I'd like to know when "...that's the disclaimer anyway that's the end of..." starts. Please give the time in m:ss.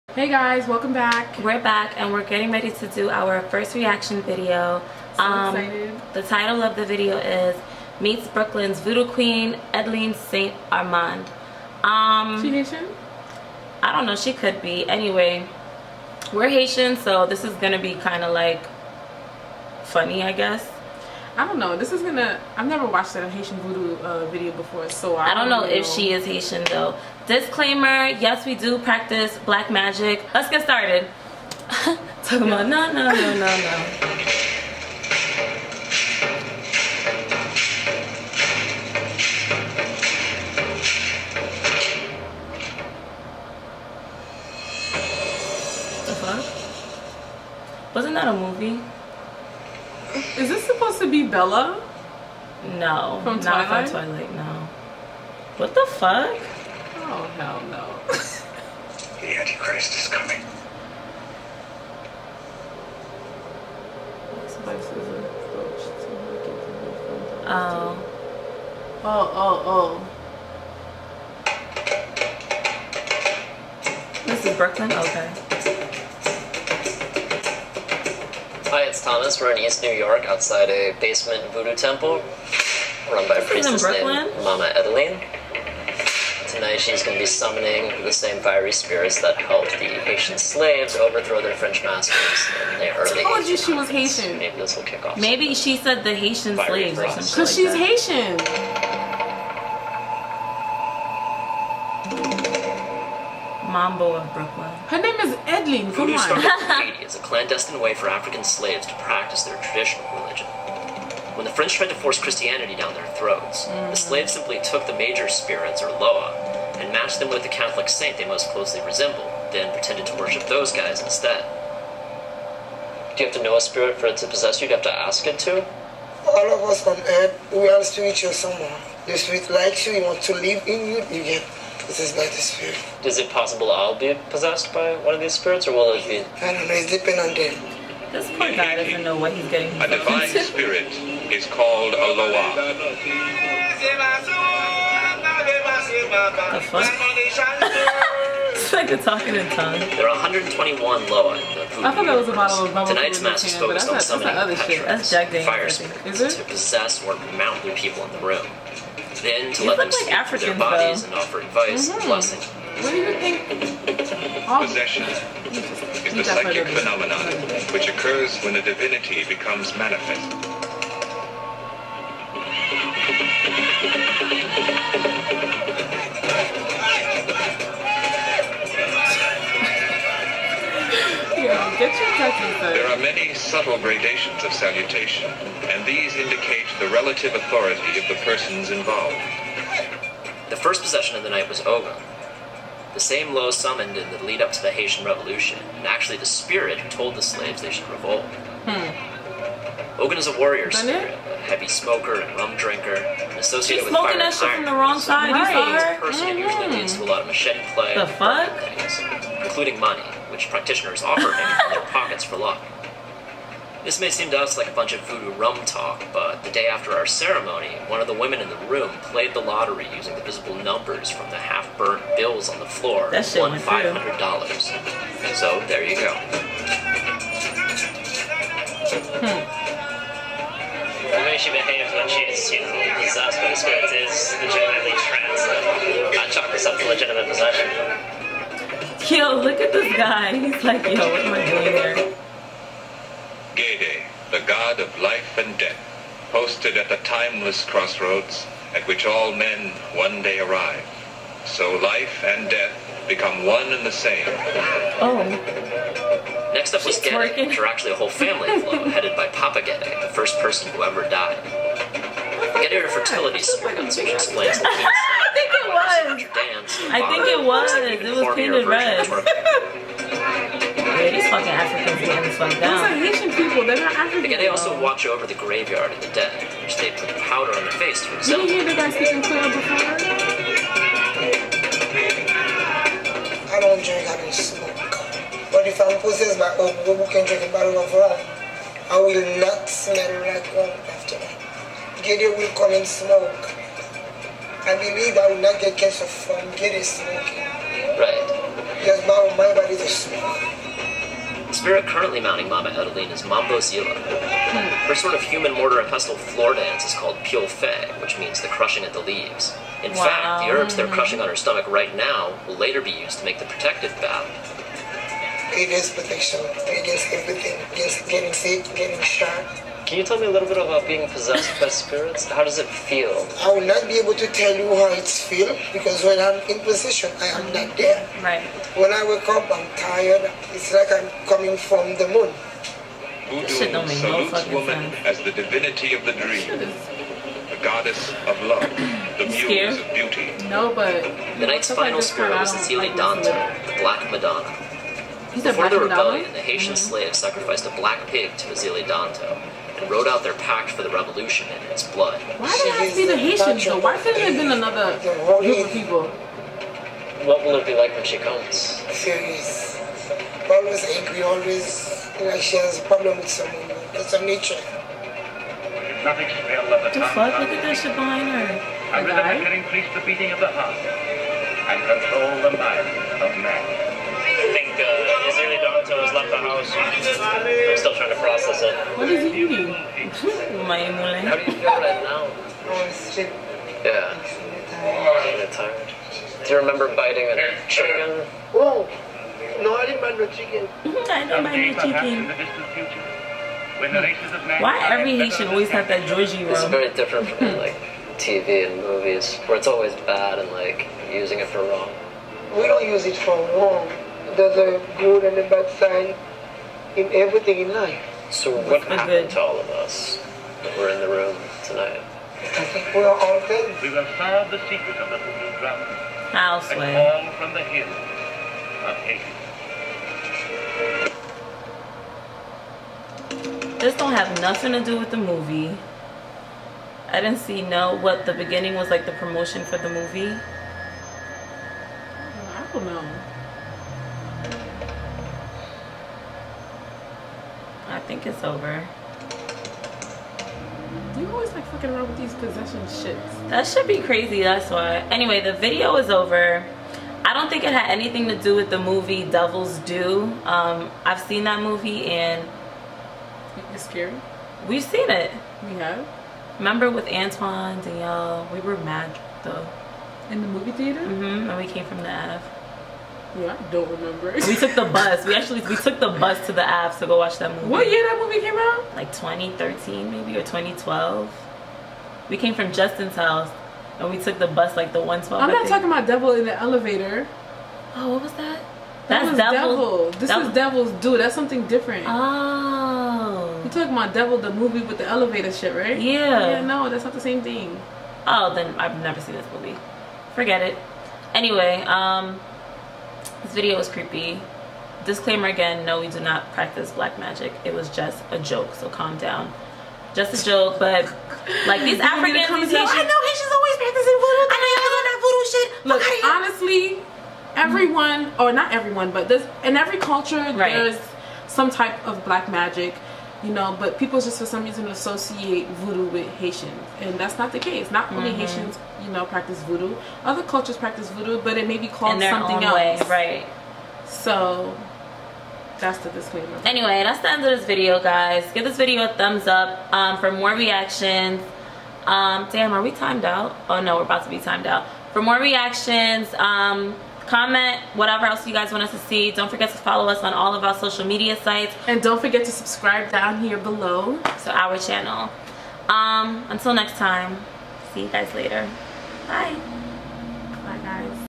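8:45.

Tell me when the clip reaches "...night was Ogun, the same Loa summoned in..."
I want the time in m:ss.
3:11.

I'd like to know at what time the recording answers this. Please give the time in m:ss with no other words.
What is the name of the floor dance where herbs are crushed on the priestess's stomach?
5:07.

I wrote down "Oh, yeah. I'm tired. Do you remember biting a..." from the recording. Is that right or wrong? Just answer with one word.
right.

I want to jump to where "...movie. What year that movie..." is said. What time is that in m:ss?
7:47.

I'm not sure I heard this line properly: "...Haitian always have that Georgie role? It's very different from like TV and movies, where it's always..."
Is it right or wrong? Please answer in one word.
right.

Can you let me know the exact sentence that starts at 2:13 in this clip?
Is it possible I'll be possessed by one of these spirits, or will it be?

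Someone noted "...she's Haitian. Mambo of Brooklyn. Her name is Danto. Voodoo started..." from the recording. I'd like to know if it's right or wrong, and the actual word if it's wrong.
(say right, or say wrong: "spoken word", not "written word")
wrong: "Edeline", not "Danto".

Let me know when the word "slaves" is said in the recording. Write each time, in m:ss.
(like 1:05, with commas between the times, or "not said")
1:30, 1:36, 1:48, 1:53, 3:17.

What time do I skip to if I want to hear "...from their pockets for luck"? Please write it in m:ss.
3:31.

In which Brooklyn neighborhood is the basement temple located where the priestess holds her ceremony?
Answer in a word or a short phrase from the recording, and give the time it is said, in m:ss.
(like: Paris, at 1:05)
East New York, at 1:19.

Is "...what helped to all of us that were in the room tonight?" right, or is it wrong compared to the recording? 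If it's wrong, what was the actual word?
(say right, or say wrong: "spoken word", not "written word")
wrong: "happened", not "helped".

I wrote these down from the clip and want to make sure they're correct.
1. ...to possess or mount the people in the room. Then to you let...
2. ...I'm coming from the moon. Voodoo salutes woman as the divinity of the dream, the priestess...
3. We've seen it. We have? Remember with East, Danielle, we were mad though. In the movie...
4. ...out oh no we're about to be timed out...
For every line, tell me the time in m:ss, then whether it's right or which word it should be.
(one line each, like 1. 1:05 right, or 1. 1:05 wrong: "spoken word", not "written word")
1. 2:36 right
2. 5:30 wrong: "goddess", not "priestess"
3. 7:34 wrong: "Antoine", not "East"
4. 8:53 right.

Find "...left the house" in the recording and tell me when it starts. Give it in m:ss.
6:16.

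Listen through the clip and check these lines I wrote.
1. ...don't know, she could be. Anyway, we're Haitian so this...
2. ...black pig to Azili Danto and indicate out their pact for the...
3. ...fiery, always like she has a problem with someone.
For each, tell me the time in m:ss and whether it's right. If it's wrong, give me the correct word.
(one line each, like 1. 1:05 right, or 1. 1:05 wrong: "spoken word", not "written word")
1. 0:13 right
2. 5:47 wrong: "wrote", not "indicate"
3. 6:00 wrong: "angry", not "fiery".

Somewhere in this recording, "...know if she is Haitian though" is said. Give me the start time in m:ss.
0:25.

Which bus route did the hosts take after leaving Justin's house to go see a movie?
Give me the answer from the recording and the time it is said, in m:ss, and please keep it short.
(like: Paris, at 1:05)
112, at 7:54.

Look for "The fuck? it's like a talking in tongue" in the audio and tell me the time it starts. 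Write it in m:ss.
2:26.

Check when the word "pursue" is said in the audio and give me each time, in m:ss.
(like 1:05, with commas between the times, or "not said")
not said.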